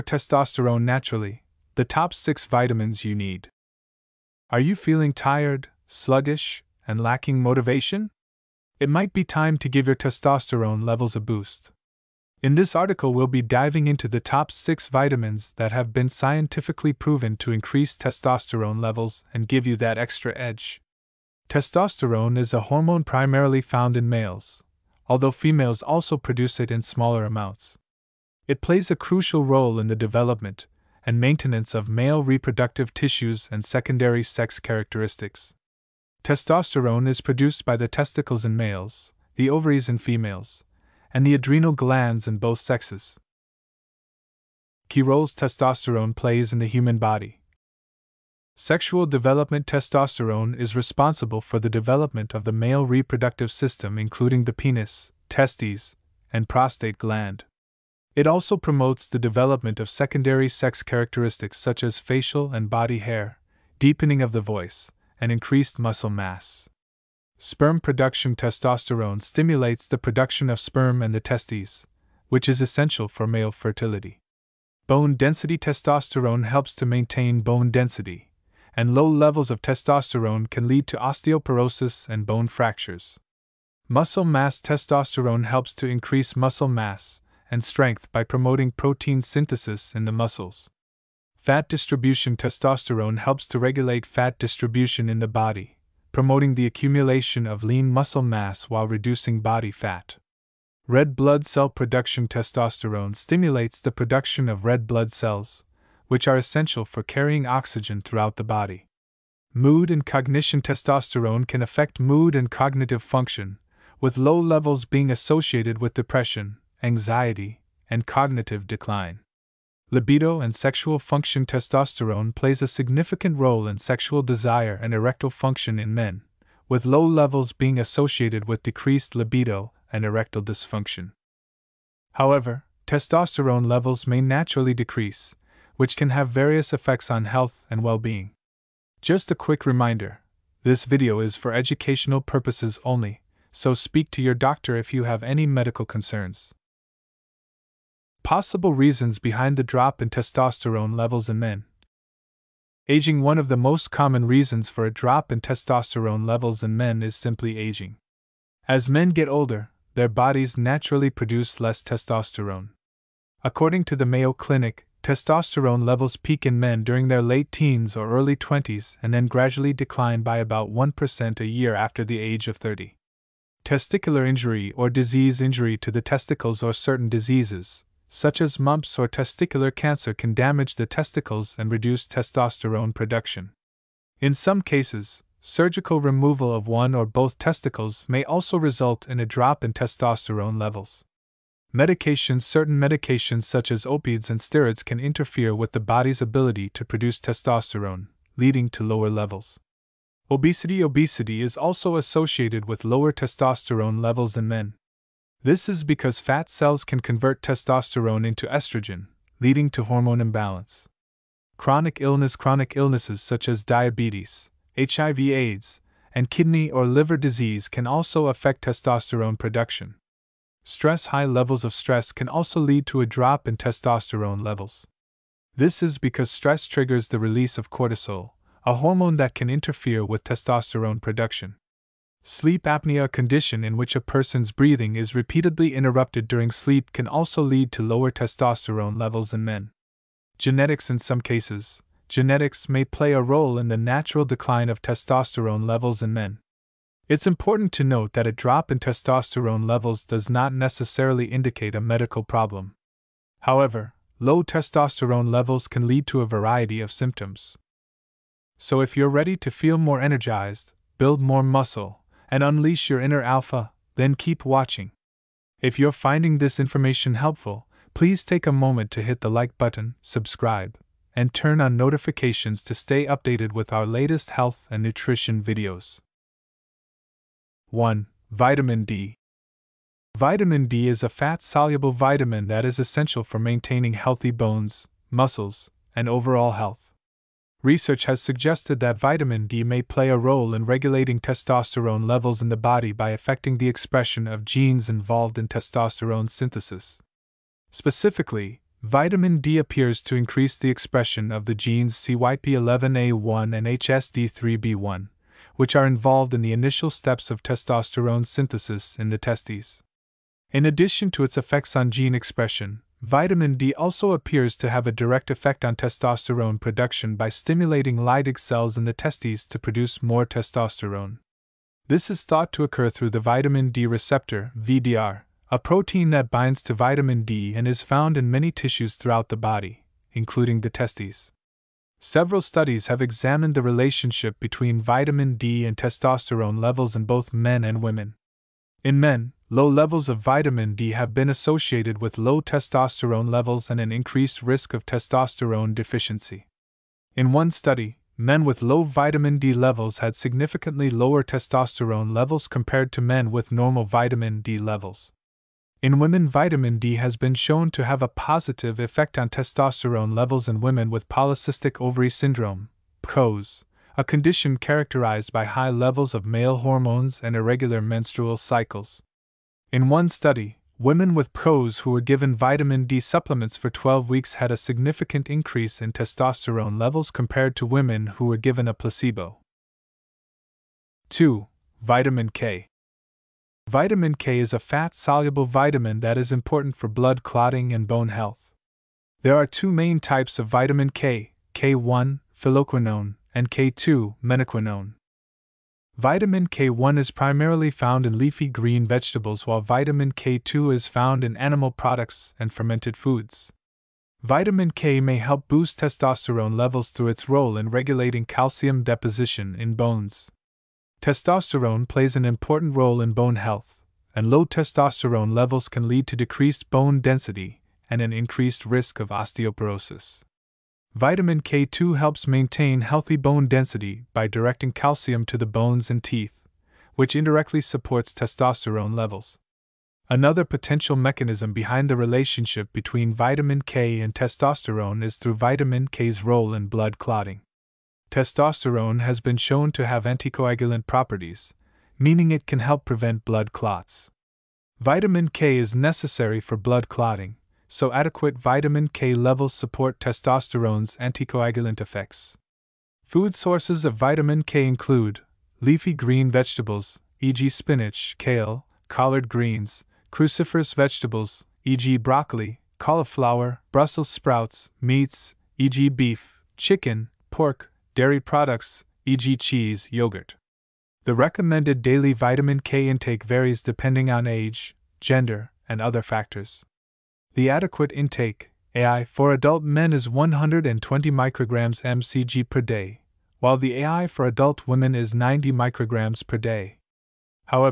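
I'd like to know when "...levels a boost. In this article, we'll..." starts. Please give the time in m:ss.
0:10.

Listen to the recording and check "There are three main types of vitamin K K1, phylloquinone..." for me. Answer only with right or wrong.
wrong.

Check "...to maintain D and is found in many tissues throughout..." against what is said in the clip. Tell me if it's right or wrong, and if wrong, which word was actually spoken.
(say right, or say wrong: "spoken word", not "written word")
wrong: "vitamin", not "maintain".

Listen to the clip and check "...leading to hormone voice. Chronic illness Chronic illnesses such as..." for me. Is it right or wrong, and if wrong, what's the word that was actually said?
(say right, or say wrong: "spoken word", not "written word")
wrong: "imbalance", not "voice".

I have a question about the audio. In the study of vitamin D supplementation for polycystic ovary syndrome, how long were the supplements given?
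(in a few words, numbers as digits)
12 weeks.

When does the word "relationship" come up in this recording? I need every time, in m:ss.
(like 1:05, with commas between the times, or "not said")
5:33, 7:11.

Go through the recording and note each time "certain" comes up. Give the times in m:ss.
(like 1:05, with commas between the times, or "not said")
2:56, 3:12.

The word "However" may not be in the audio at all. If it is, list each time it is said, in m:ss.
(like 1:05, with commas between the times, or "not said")
2:12, 4:13.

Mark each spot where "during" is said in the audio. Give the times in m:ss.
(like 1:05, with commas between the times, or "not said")
2:46, 3:56.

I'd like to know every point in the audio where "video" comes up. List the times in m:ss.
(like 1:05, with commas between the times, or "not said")
2:20, 4:35.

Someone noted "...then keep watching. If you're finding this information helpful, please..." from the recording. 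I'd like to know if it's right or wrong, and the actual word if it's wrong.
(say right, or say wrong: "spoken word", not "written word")
right.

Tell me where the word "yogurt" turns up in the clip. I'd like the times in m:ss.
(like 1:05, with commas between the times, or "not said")
7:49.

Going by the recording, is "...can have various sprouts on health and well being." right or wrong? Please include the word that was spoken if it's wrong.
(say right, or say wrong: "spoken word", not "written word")
wrong: "effects", not "sprouts".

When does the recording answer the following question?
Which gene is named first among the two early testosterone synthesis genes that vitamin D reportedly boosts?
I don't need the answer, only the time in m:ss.
5:01.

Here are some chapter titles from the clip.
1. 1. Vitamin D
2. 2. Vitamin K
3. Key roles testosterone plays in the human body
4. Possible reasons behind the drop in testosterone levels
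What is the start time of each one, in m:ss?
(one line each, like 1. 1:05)
1. 4:37
2. 6:20
3. 0:46
4. 2:31.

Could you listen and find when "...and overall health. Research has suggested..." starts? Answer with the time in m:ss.
4:45.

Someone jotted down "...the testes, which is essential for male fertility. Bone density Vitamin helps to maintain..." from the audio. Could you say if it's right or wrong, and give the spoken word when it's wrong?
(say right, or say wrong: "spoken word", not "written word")
wrong: "Testosterone", not "Vitamin".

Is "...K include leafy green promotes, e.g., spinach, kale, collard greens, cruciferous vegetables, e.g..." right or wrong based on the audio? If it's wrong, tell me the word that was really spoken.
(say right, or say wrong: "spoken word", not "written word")
wrong: "vegetables", not "promotes".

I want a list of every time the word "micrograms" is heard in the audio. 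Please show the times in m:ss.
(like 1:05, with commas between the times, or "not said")
8:01, 8:05.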